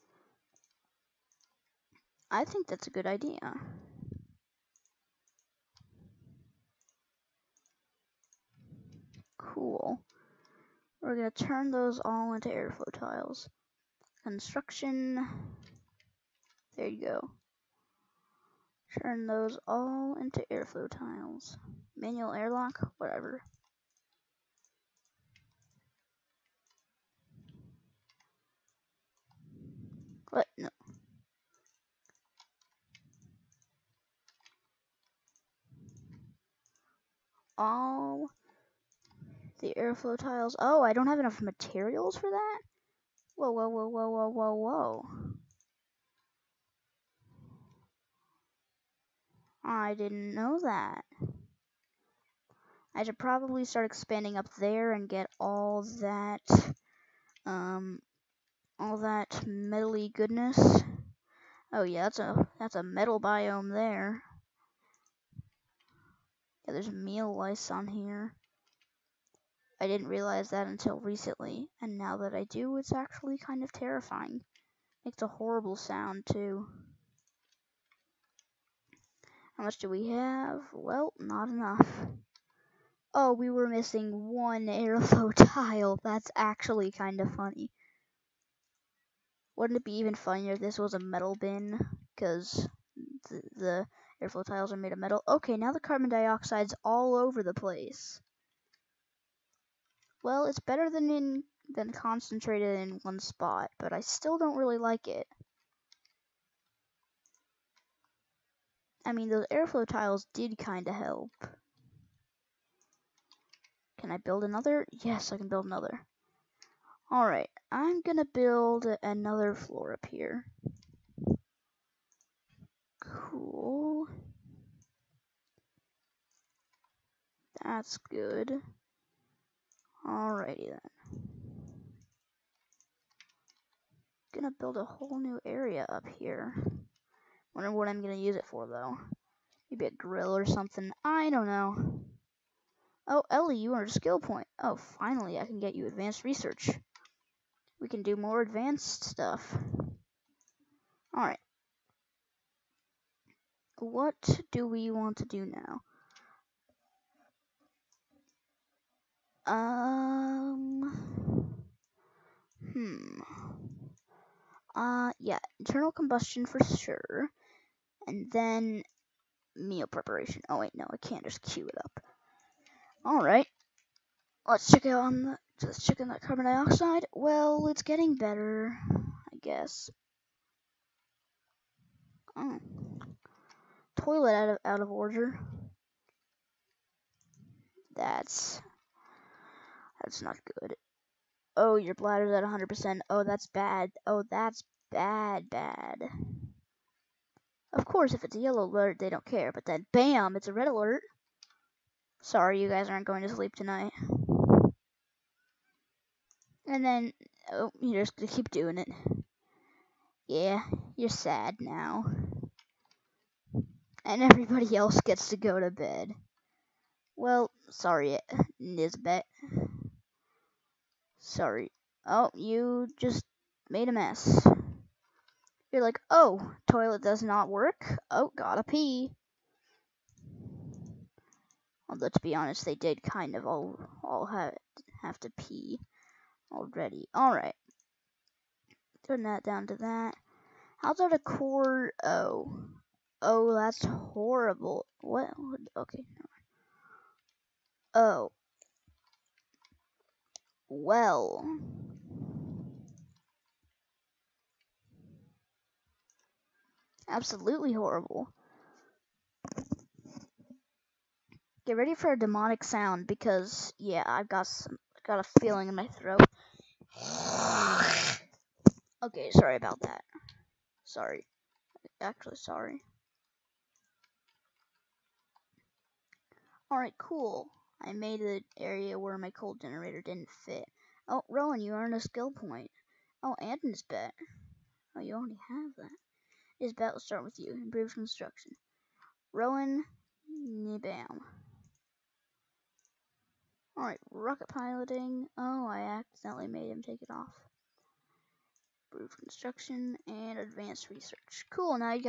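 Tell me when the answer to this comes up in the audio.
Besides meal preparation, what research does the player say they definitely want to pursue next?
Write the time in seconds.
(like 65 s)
165 s.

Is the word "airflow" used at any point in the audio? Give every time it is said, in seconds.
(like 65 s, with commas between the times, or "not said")
12 s, 20 s, 39 s, 84 s, 94 s, 109 s.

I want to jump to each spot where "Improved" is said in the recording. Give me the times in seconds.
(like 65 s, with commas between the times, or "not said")
287 s, 298 s.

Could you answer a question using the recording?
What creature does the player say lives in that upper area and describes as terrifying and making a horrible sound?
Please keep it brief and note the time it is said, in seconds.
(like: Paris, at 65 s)
meal lice, at 66 s.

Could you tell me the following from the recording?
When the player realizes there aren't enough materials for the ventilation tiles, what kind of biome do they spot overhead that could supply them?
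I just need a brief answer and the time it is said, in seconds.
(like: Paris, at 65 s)
metal biome, at 62 s.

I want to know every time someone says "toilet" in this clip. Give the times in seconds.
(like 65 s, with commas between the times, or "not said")
184 s, 226 s.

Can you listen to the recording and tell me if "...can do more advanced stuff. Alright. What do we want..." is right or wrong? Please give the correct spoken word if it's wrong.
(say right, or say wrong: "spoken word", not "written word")
right.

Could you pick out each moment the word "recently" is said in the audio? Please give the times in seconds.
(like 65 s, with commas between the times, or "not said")
71 s.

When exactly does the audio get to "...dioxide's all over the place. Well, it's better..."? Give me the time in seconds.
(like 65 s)
96 s.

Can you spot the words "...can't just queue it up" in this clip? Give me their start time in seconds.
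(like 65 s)
170 s.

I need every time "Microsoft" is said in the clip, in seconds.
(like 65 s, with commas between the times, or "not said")
not said.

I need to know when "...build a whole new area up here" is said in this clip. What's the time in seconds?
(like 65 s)
134 s.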